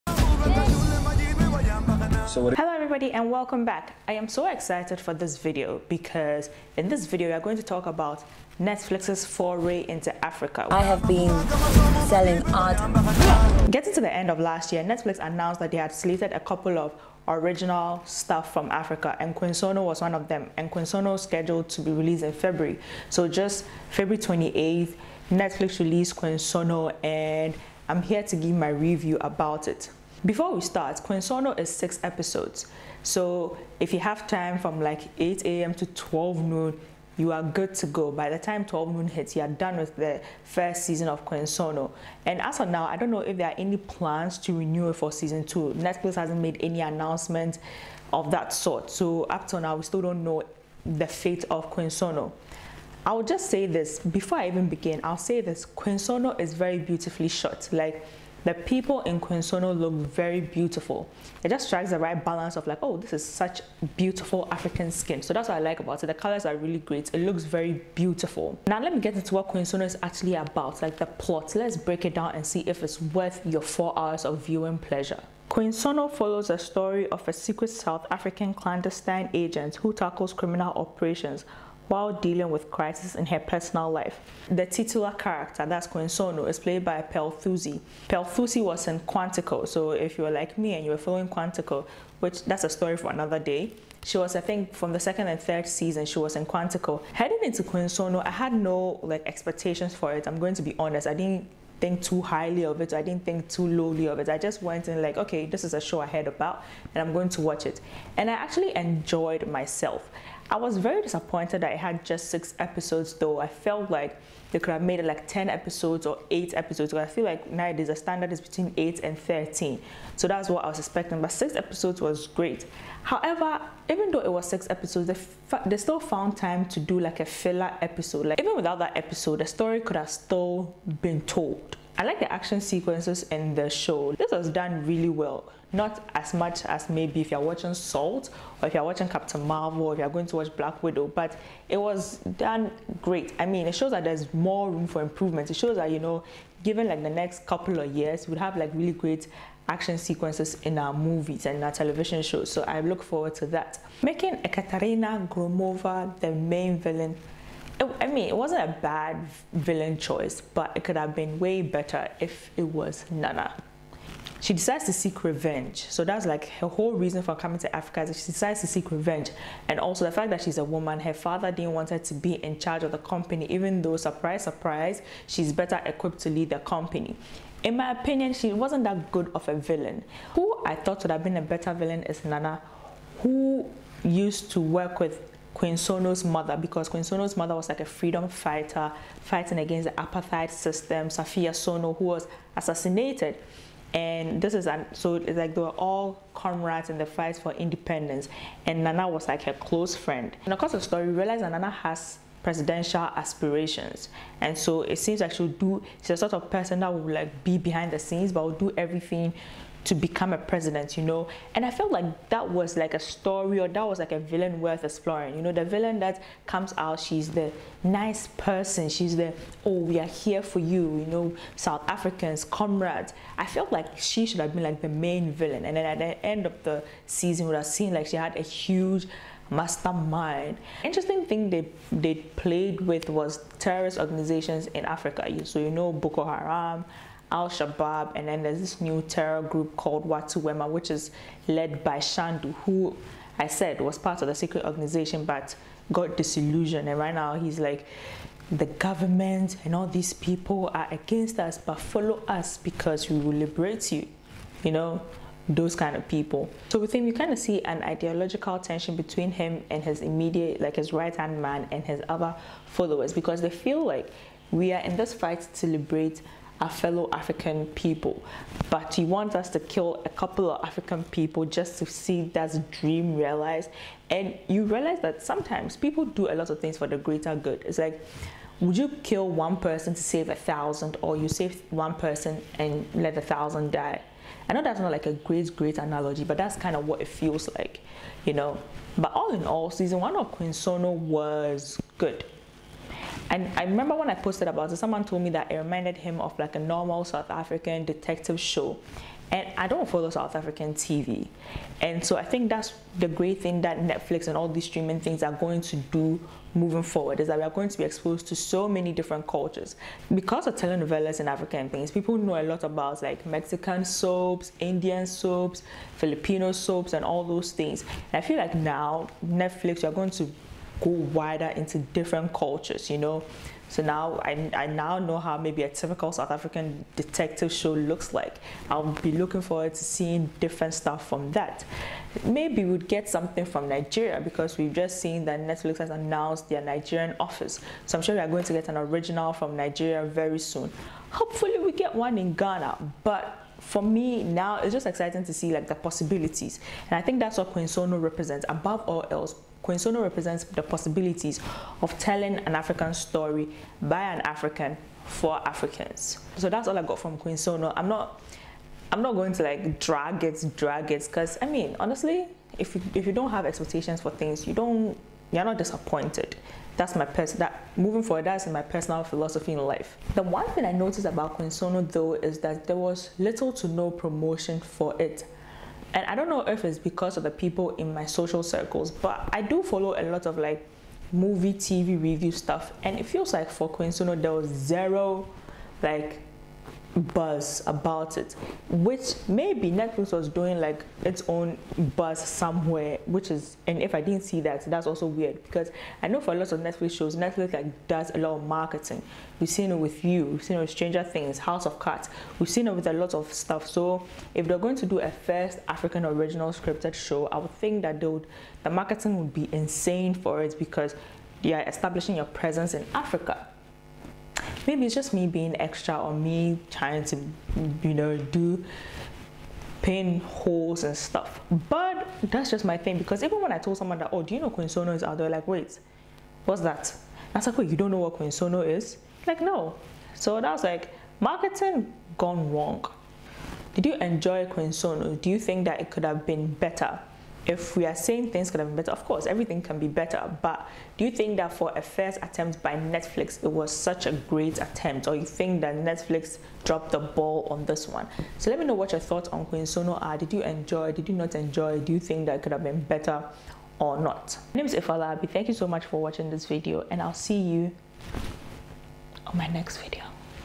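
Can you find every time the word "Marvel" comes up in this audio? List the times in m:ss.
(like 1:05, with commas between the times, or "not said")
2:19.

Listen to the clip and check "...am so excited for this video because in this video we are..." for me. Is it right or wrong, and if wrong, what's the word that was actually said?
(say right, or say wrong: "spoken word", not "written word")
right.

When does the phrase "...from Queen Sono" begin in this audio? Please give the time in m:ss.
5:56.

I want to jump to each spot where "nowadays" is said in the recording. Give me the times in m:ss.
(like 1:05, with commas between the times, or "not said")
1:57.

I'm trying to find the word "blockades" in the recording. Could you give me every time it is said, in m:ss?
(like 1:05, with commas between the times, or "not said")
not said.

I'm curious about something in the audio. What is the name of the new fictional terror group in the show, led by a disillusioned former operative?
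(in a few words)
Watu Wema.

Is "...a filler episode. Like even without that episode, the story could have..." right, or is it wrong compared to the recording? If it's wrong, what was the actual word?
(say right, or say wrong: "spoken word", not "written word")
right.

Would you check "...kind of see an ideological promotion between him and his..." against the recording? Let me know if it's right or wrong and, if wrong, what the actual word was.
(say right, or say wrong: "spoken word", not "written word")
wrong: "tension", not "promotion".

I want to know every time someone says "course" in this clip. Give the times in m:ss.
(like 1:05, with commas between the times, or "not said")
7:19.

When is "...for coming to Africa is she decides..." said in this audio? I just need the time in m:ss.
2:47.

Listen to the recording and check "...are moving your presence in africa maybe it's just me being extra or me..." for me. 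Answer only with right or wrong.
wrong.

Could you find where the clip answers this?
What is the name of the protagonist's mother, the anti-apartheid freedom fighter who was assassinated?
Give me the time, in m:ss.
3:11.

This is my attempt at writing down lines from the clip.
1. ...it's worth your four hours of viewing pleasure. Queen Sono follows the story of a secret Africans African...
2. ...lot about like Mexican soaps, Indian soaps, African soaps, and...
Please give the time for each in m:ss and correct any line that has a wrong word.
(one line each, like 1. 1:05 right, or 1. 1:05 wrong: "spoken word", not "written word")
1. 1:12 wrong: "South", not "Africans"
2. 5:12 wrong: "Filipino", not "African".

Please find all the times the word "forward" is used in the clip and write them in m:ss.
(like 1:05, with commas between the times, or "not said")
2:33, 5:06, 5:29, 6:08.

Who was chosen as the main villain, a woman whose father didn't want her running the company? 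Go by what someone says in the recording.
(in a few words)
Ekaterina Gromova.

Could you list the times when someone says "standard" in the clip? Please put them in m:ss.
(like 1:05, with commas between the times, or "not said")
1:57.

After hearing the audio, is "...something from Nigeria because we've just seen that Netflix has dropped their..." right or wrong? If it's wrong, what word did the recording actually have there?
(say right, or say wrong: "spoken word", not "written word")
wrong: "announced", not "dropped".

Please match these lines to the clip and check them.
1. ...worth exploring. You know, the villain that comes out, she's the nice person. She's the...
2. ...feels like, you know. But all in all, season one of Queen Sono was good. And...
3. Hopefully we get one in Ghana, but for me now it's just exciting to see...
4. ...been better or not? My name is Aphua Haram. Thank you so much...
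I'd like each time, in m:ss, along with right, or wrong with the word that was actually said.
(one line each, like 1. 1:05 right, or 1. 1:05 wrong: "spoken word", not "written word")
1. 3:34 right
2. 4:47 right
3. 5:41 right
4. 7:32 wrong: "Larbi", not "Haram".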